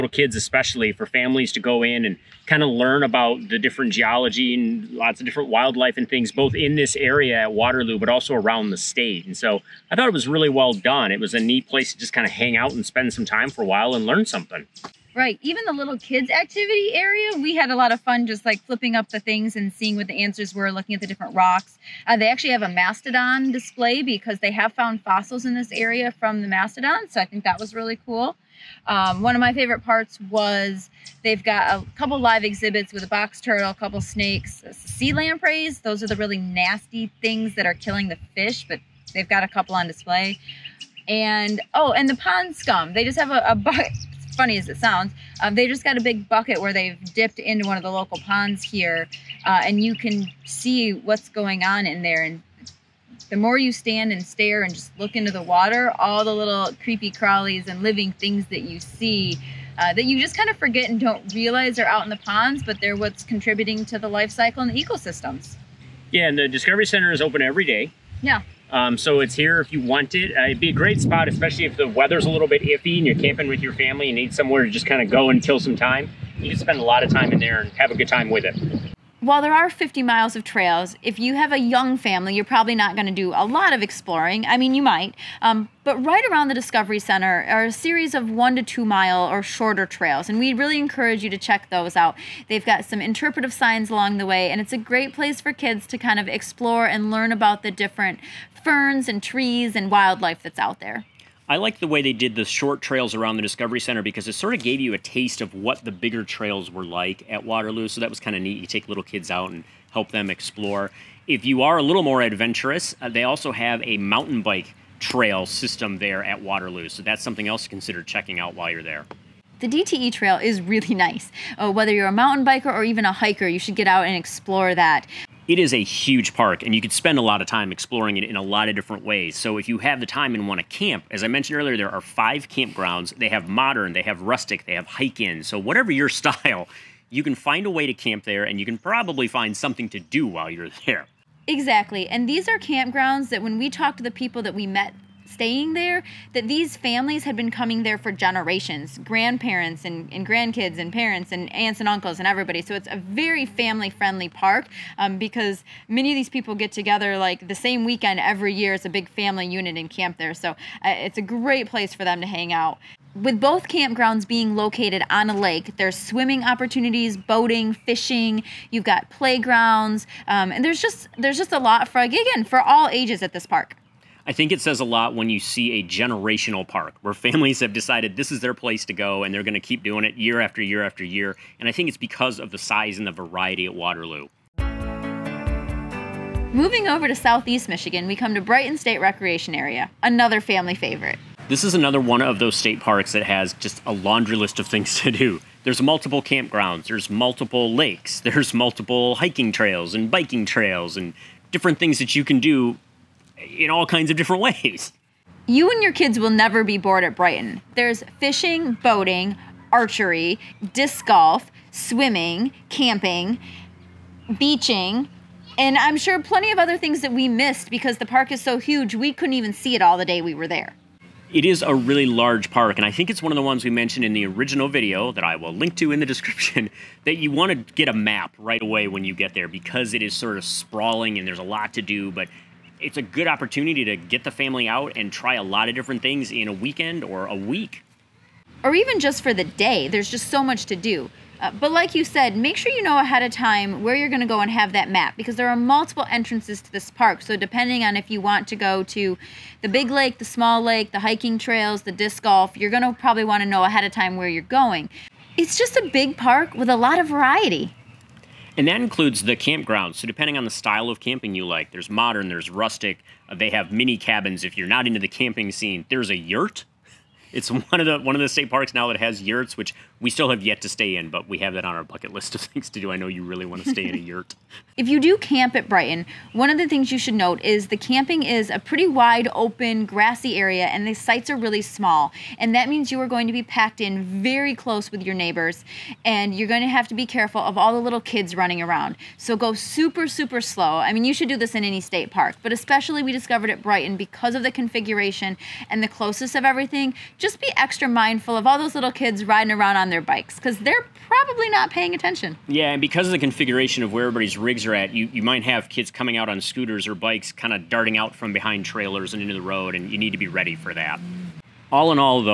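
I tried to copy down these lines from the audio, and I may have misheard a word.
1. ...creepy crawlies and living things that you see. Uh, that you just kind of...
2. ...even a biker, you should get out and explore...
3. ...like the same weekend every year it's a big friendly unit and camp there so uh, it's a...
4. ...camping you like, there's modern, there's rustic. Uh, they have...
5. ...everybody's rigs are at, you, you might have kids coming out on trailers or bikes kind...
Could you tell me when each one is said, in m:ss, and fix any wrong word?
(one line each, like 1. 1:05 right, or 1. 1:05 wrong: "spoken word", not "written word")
1. 0:56 right
2. 2:02 wrong: "hiker", not "biker"
3. 2:37 wrong: "family", not "friendly"
4. 4:20 right
5. 5:04 wrong: "scooters", not "trailers".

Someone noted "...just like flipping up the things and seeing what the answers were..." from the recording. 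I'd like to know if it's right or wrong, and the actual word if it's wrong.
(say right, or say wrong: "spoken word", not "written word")
right.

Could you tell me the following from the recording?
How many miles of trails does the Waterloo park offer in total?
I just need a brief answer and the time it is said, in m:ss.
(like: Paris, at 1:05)
50, at 1:19.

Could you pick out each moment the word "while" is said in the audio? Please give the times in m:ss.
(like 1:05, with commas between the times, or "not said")
0:13, 1:19, 1:58, 2:20.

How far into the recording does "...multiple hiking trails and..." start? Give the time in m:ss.
3:18.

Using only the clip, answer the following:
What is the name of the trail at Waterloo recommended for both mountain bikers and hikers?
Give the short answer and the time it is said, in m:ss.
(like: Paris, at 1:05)
DTE trail, at 1:59.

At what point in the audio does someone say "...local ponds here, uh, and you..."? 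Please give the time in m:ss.
0:47.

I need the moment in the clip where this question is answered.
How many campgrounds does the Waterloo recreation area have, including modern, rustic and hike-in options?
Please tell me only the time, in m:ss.
2:12.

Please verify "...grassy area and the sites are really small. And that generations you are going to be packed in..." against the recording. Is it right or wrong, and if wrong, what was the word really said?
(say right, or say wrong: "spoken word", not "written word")
wrong: "means", not "generations".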